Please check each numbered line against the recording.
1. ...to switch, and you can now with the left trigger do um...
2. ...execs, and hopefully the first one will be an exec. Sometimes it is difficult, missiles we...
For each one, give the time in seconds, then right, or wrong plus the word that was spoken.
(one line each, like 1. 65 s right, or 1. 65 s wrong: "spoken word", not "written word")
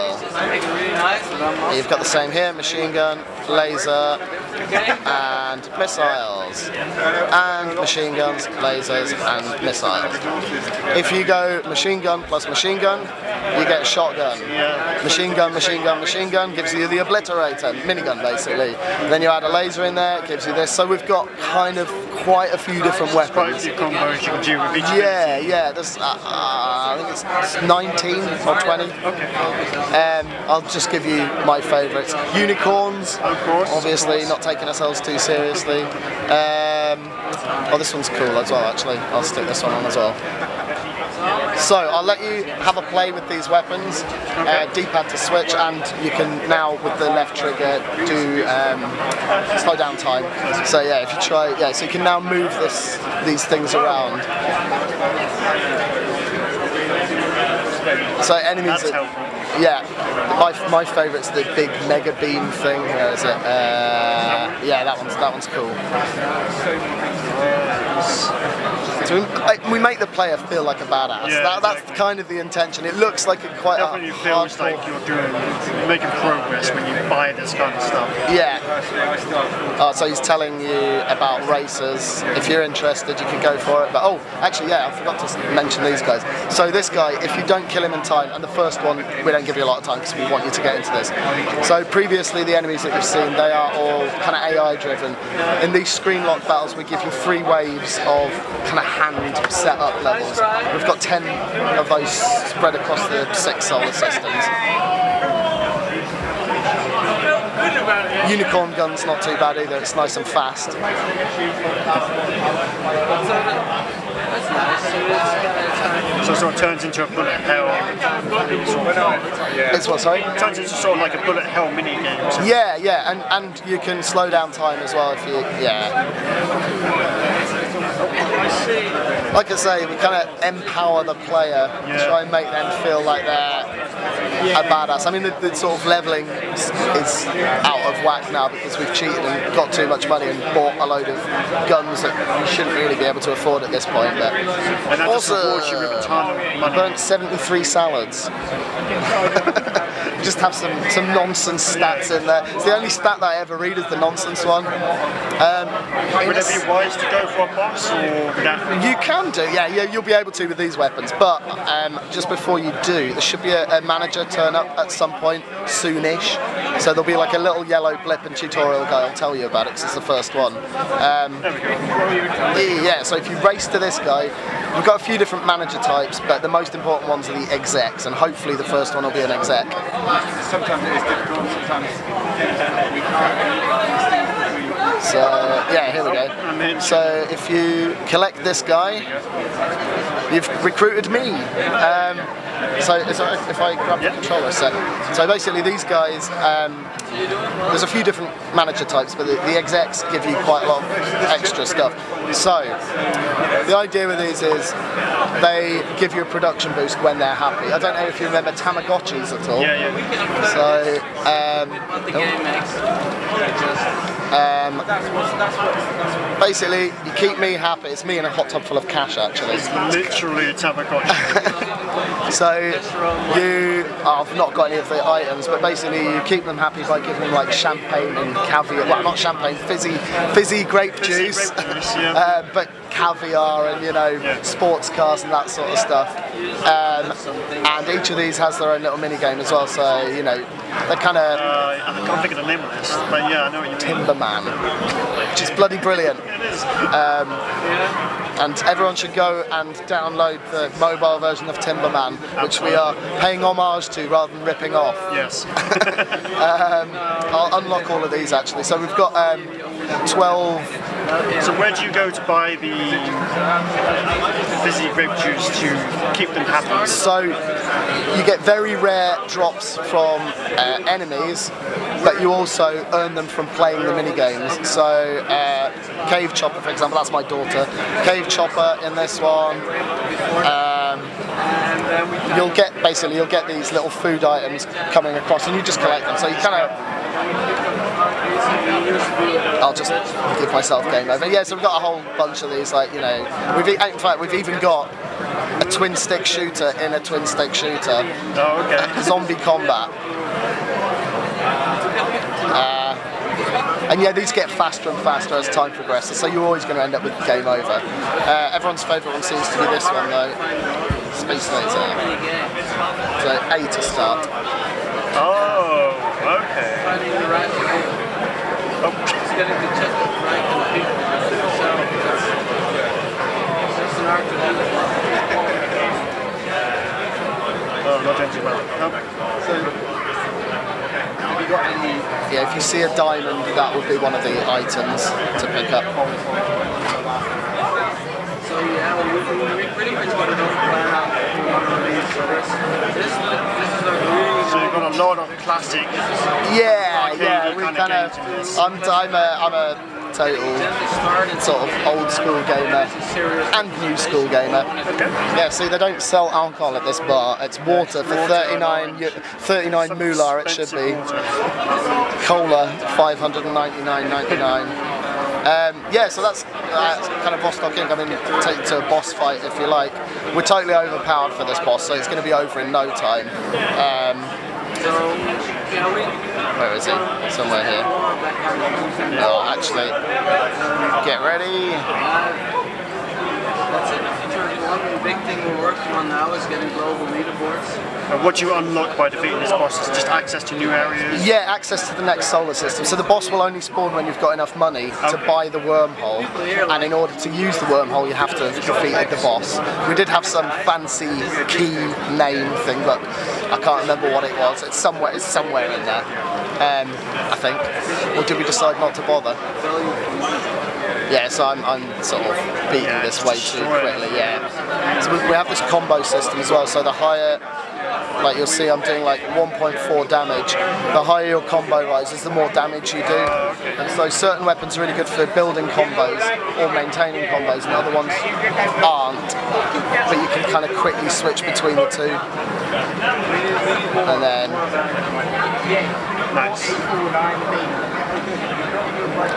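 1. 45 s right
2. 177 s wrong: "sometimes", not "missiles".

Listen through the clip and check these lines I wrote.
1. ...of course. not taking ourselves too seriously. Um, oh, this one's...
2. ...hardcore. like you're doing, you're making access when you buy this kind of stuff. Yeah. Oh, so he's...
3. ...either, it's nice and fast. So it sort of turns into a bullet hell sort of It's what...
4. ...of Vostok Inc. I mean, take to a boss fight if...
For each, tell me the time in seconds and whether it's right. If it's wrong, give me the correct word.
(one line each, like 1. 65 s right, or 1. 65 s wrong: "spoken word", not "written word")
1. 34 s right
2. 74 s wrong: "progress", not "access"
3. 109 s right
4. 367 s right.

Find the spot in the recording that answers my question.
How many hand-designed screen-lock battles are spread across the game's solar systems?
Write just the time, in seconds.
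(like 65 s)
100 s.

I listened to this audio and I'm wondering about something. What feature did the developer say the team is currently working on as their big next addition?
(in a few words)
Global leaderboards.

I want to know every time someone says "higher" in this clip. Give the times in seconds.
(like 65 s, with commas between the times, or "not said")
416 s, 421 s.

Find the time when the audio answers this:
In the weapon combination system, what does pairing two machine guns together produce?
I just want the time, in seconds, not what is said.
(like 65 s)
13 s.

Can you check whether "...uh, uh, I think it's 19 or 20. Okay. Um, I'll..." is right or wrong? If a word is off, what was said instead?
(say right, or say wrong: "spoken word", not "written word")
right.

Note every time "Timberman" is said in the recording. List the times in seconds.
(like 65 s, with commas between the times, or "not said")
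243 s, 251 s.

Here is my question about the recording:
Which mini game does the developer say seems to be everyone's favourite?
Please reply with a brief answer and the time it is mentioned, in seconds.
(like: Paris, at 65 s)
Space Laser, at 311 s.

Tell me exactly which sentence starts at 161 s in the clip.
But um, just before you do, there should be a, a manager turn up at some point soonish.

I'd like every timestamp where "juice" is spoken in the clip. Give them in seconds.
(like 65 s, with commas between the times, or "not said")
231 s, 265 s.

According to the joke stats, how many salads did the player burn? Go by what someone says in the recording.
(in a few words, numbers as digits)
73.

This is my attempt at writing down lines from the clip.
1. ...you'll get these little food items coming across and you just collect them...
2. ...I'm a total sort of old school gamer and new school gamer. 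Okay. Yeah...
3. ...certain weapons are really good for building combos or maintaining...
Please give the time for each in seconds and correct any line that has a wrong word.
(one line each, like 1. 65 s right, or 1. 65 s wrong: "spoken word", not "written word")
1. 283 s right
2. 349 s right
3. 424 s right.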